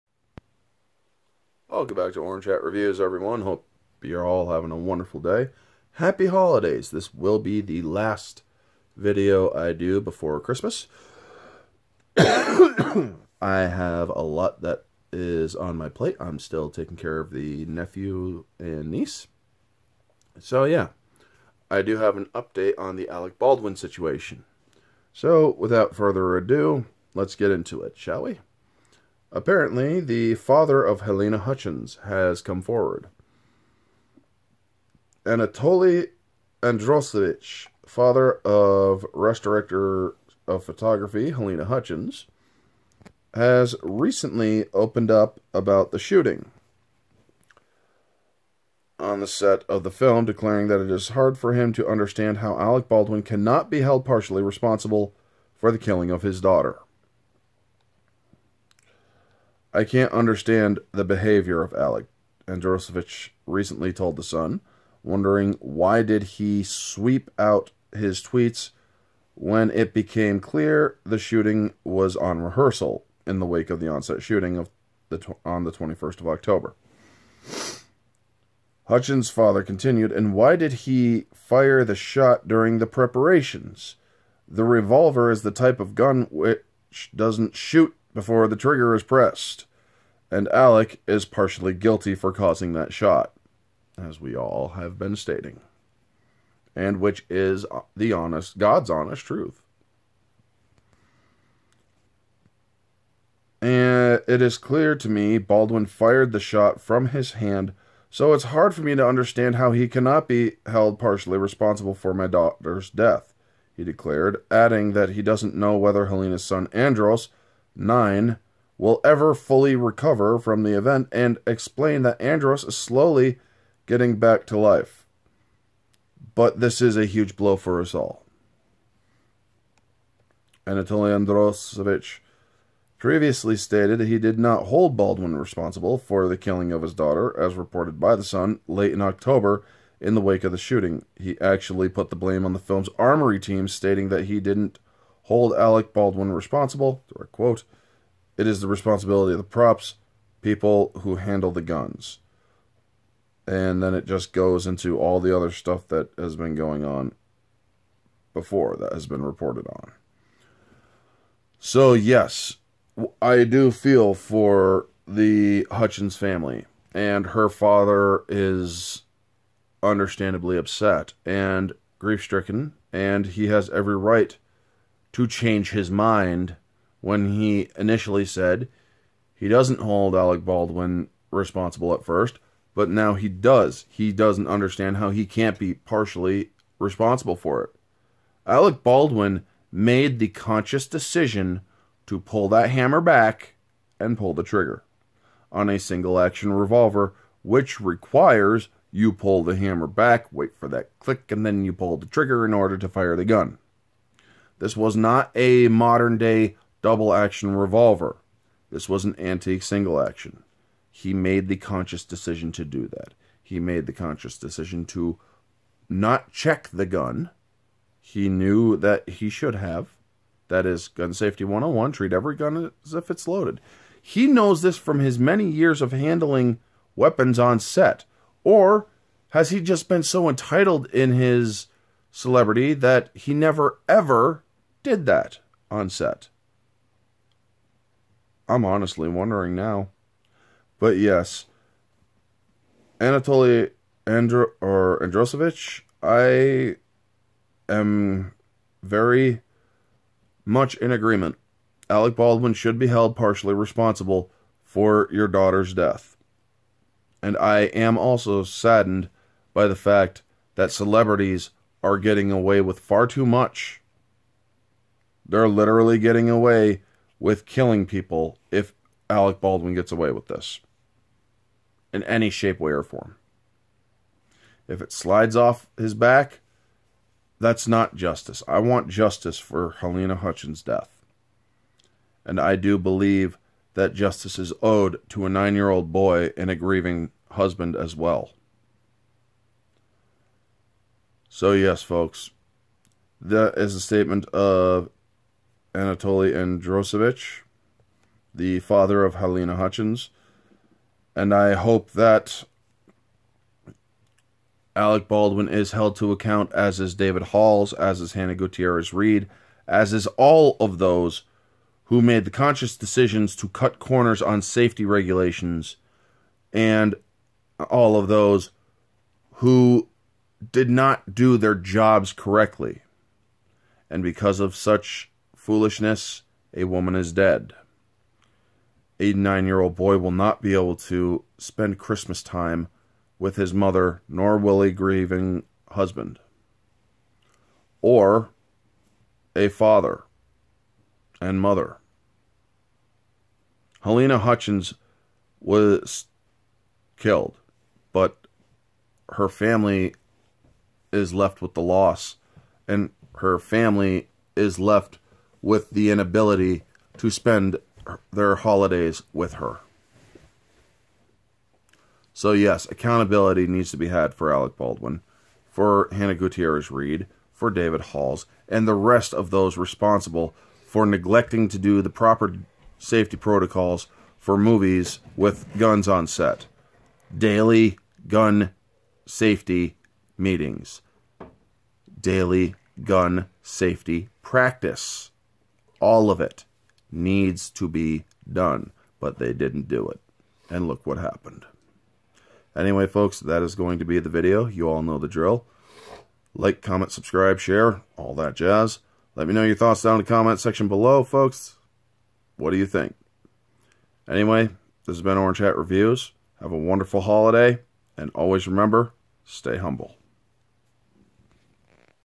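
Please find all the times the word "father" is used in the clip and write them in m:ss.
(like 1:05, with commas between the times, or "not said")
0:30, 0:37, 1:19, 2:47, 4:58, 5:39.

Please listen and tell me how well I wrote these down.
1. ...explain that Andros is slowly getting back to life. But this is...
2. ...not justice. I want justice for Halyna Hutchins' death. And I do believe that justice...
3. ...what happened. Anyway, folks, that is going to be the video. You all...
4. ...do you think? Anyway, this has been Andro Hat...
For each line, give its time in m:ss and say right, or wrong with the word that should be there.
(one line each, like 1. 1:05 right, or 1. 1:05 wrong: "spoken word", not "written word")
1. 2:01 right
2. 4:37 right
3. 6:30 right
4. 6:42 wrong: "Orange", not "Andro".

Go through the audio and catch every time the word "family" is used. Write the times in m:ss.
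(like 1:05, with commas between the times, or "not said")
2:46, 5:49, 5:53.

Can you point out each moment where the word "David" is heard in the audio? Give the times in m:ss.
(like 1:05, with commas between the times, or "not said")
5:06, 6:07.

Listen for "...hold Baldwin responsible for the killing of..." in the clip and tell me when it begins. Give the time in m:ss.
2:14.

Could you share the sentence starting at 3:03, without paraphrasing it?
He doesn't understand how he can't be partially responsible for it.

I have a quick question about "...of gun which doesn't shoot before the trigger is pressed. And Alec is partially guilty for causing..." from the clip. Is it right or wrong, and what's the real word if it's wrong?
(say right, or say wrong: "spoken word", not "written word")
right.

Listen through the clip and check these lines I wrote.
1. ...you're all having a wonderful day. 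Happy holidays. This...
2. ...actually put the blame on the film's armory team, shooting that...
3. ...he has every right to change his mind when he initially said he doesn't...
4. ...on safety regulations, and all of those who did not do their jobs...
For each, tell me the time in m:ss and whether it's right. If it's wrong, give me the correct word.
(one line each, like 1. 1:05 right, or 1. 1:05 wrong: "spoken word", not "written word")
1. 0:04 right
2. 2:21 wrong: "stating", not "shooting"
3. 2:53 right
4. 5:14 right.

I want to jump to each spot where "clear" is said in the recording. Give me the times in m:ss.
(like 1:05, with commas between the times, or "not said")
1:10, 1:44.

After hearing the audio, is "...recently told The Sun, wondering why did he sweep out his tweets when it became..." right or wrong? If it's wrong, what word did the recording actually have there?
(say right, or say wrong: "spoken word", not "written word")
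right.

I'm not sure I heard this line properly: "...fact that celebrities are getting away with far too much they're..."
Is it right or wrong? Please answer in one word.
right.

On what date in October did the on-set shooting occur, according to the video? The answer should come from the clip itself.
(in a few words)
21st of October.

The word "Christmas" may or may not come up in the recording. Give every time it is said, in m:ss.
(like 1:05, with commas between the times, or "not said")
0:10, 5:31.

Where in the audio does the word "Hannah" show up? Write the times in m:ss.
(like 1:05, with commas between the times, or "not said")
5:08, 6:05.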